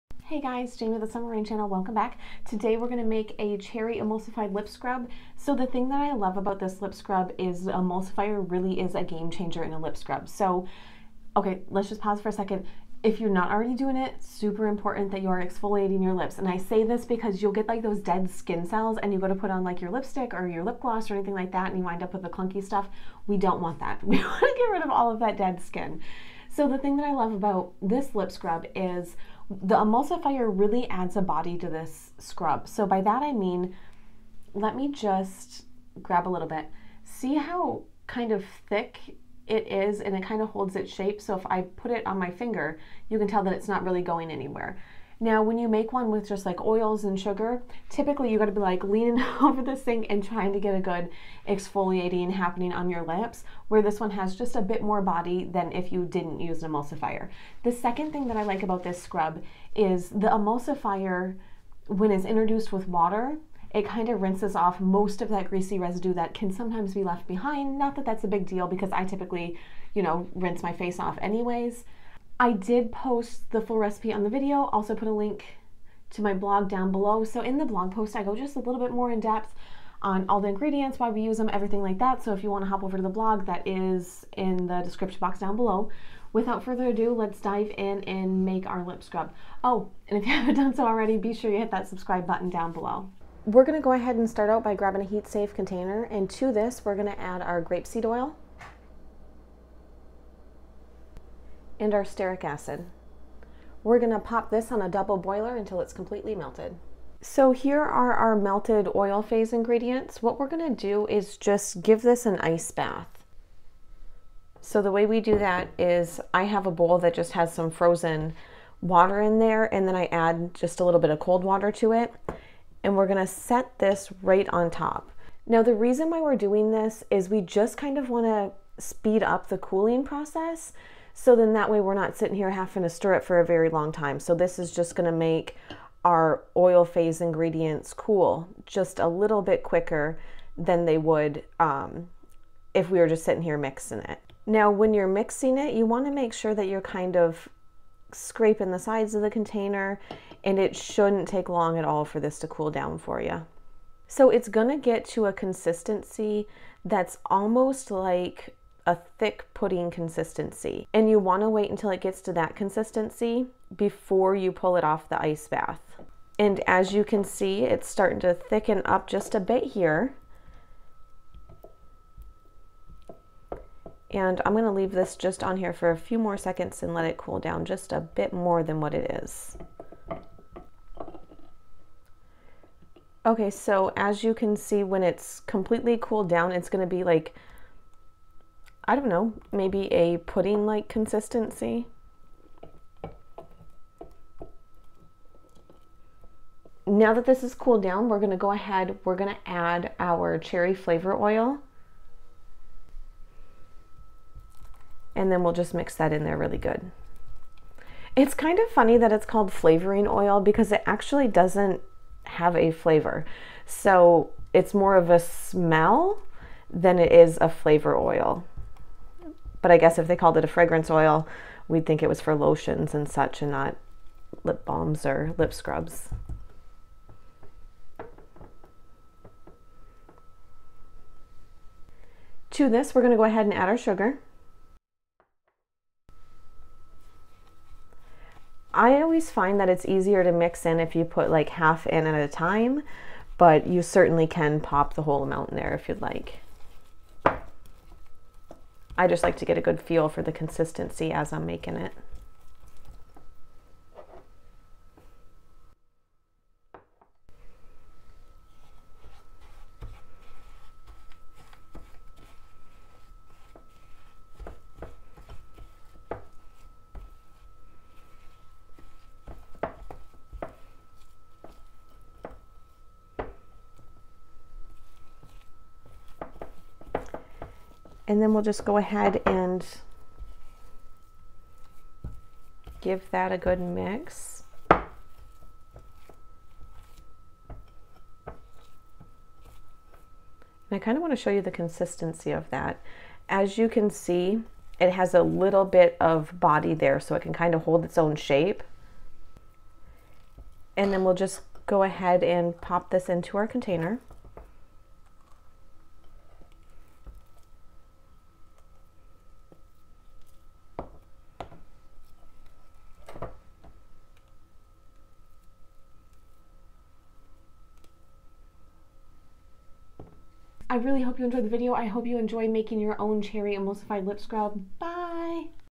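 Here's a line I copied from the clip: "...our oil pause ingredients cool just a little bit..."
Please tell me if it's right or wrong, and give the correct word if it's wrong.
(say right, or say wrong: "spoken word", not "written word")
wrong: "phase", not "pause".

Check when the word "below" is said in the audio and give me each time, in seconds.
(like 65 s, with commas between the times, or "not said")
76 s, 85 s, 92 s.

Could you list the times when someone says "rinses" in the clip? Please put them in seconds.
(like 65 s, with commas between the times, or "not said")
64 s, 70 s.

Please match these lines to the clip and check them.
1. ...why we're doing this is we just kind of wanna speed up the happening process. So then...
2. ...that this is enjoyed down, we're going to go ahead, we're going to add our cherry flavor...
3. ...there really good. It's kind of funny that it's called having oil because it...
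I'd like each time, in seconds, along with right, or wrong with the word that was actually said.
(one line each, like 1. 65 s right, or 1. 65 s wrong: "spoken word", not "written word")
1. 126 s wrong: "cooling", not "happening"
2. 197 s wrong: "cooled", not "enjoyed"
3. 206 s wrong: "flavoring", not "having".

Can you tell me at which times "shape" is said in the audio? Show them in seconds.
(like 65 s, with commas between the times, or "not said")
40 s, 298 s.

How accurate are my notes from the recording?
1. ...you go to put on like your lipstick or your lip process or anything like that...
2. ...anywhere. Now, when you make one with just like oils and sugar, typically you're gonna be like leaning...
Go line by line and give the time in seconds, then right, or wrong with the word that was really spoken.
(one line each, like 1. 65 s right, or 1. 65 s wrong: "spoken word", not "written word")
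1. 19 s wrong: "gloss", not "process"
2. 44 s right.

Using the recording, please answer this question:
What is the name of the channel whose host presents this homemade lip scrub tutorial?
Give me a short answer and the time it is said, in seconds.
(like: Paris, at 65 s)
Summer Rain Channel, at 1 s.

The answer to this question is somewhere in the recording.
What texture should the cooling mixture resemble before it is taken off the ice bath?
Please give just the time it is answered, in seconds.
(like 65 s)
159 s.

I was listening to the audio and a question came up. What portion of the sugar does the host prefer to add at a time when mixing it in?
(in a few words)
half.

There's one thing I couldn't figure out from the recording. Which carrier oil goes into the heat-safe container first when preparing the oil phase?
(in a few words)
grapeseed oil.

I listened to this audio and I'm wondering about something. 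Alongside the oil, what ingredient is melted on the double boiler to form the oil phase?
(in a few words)
stearic acid.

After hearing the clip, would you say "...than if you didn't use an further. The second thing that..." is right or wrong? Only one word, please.
wrong.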